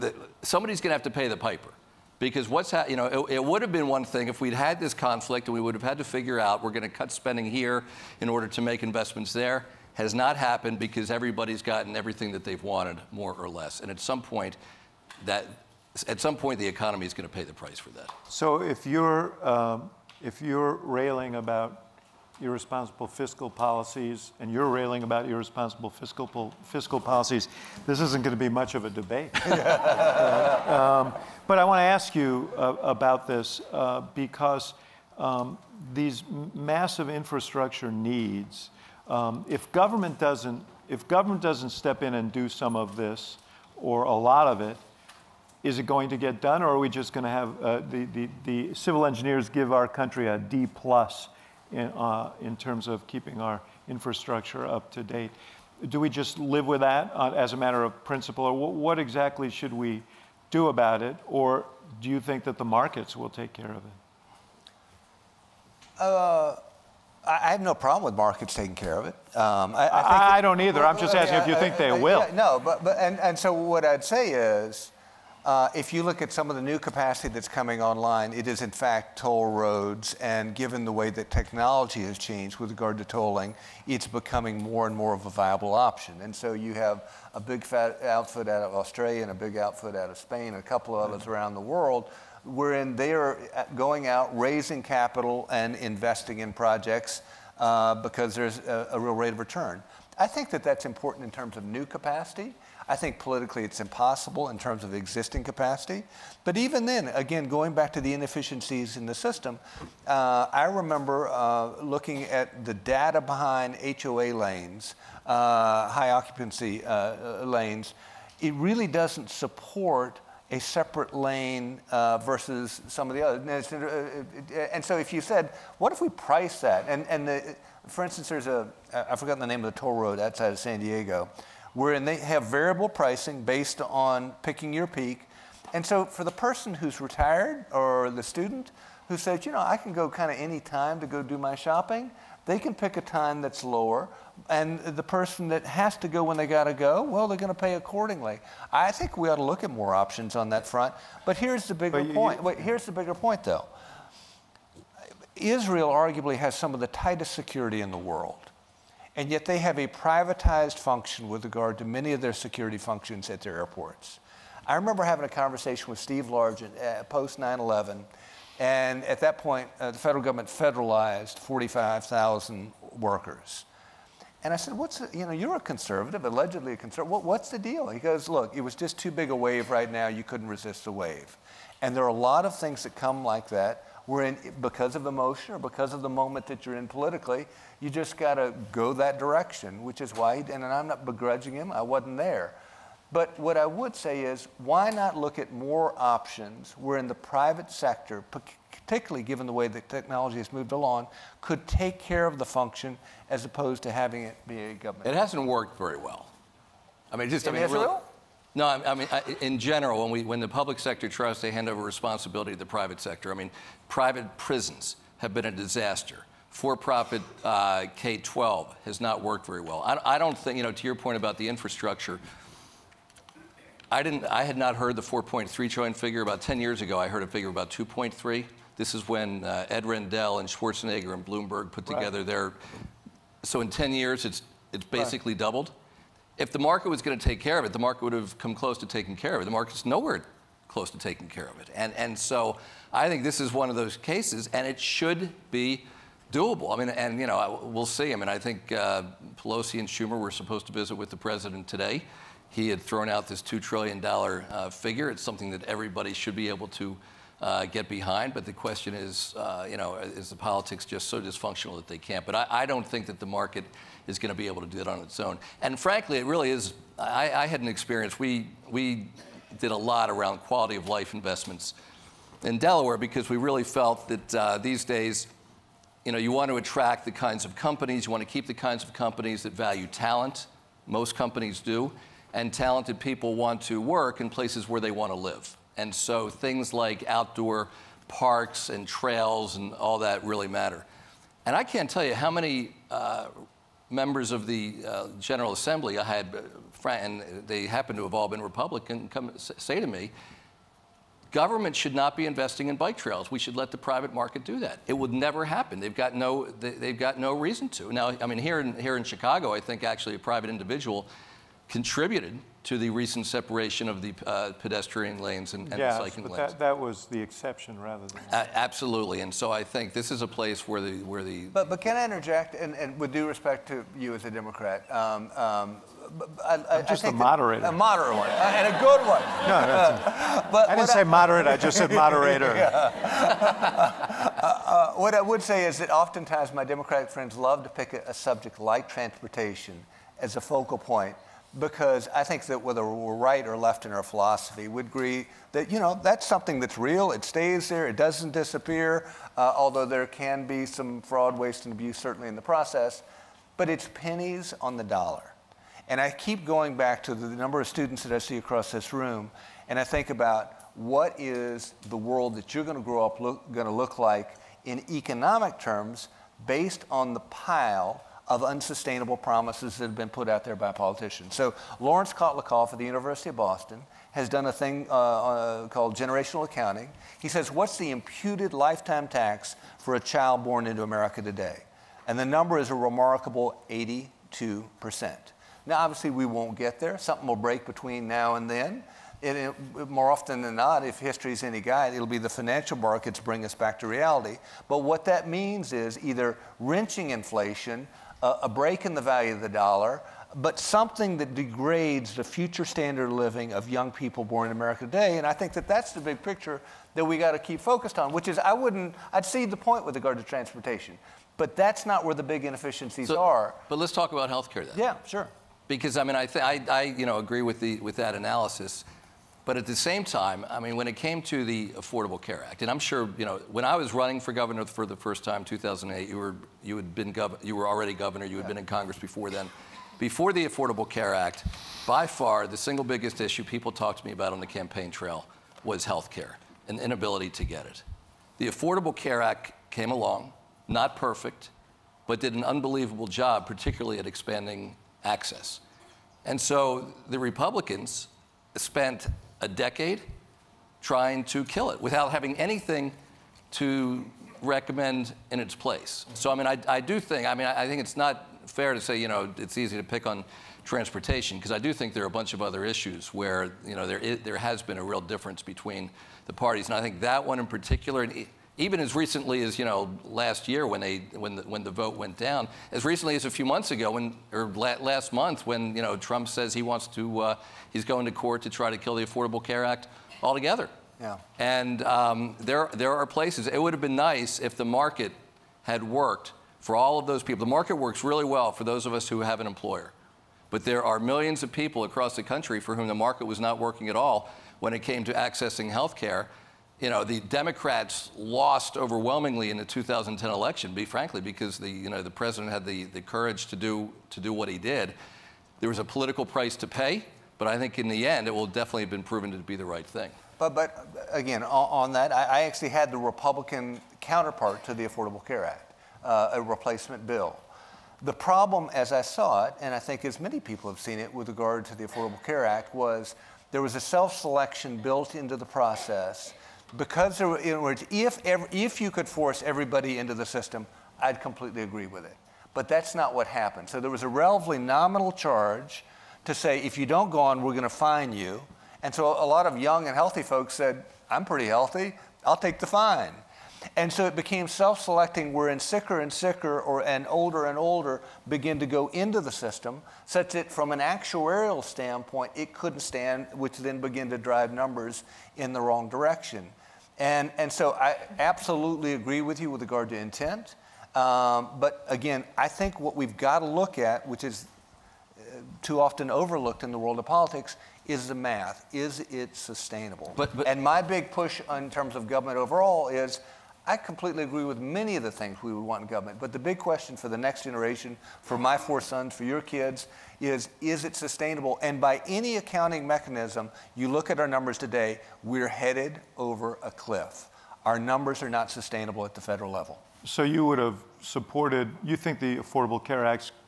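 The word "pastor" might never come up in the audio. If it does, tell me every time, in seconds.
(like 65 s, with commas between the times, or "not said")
not said.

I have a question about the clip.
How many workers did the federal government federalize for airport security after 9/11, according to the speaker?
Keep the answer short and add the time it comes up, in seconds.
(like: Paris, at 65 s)
45,000, at 171 s.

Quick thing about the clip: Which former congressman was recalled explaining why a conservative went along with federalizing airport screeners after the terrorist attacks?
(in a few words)
Steve Largent.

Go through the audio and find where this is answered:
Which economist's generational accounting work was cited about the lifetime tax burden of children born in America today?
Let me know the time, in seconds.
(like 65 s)
371 s.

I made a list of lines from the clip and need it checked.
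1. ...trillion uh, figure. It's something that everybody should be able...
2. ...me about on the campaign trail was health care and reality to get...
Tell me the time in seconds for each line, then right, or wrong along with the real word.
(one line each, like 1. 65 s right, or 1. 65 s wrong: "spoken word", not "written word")
1. 253 s right
2. 434 s wrong: "inability", not "reality".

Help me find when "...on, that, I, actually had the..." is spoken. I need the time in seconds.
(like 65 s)
511 s.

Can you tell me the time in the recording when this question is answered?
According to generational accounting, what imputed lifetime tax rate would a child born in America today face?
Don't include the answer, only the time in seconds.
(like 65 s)
383 s.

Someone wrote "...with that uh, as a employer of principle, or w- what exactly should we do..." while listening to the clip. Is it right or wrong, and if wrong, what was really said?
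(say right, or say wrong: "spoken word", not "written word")
wrong: "matter", not "employer".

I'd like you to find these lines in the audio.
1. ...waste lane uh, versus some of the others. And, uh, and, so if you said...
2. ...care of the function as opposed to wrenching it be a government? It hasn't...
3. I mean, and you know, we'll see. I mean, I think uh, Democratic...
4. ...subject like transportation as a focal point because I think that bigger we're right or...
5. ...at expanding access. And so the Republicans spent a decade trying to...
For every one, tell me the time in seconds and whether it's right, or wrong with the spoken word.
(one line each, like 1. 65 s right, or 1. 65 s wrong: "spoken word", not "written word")
1. 120 s wrong: "separate", not "waste"
2. 201 s wrong: "having", not "wrenching"
3. 246 s wrong: "Pelosi", not "Democratic"
4. 338 s wrong: "whether", not "bigger"
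5. 443 s right.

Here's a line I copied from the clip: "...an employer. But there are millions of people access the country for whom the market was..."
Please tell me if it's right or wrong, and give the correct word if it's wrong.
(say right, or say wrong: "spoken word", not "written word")
wrong: "across", not "access".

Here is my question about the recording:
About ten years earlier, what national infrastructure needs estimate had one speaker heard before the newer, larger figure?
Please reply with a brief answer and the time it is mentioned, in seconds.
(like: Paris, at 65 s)
2.3 trillion, at 227 s.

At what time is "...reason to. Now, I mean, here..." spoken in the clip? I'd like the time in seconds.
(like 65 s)
307 s.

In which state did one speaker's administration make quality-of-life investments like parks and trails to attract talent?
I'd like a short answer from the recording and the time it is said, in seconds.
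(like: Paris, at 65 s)
Delaware, at 272 s.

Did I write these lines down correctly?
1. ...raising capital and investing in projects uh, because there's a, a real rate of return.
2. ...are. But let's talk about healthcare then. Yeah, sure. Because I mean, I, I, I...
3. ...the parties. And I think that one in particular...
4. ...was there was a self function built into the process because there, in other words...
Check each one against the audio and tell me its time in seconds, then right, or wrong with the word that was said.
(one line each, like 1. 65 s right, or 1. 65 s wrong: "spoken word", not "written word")
1. 94 s right
2. 413 s right
3. 466 s right
4. 522 s wrong: "selection", not "function".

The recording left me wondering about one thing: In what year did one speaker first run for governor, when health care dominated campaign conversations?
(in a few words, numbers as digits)
2008.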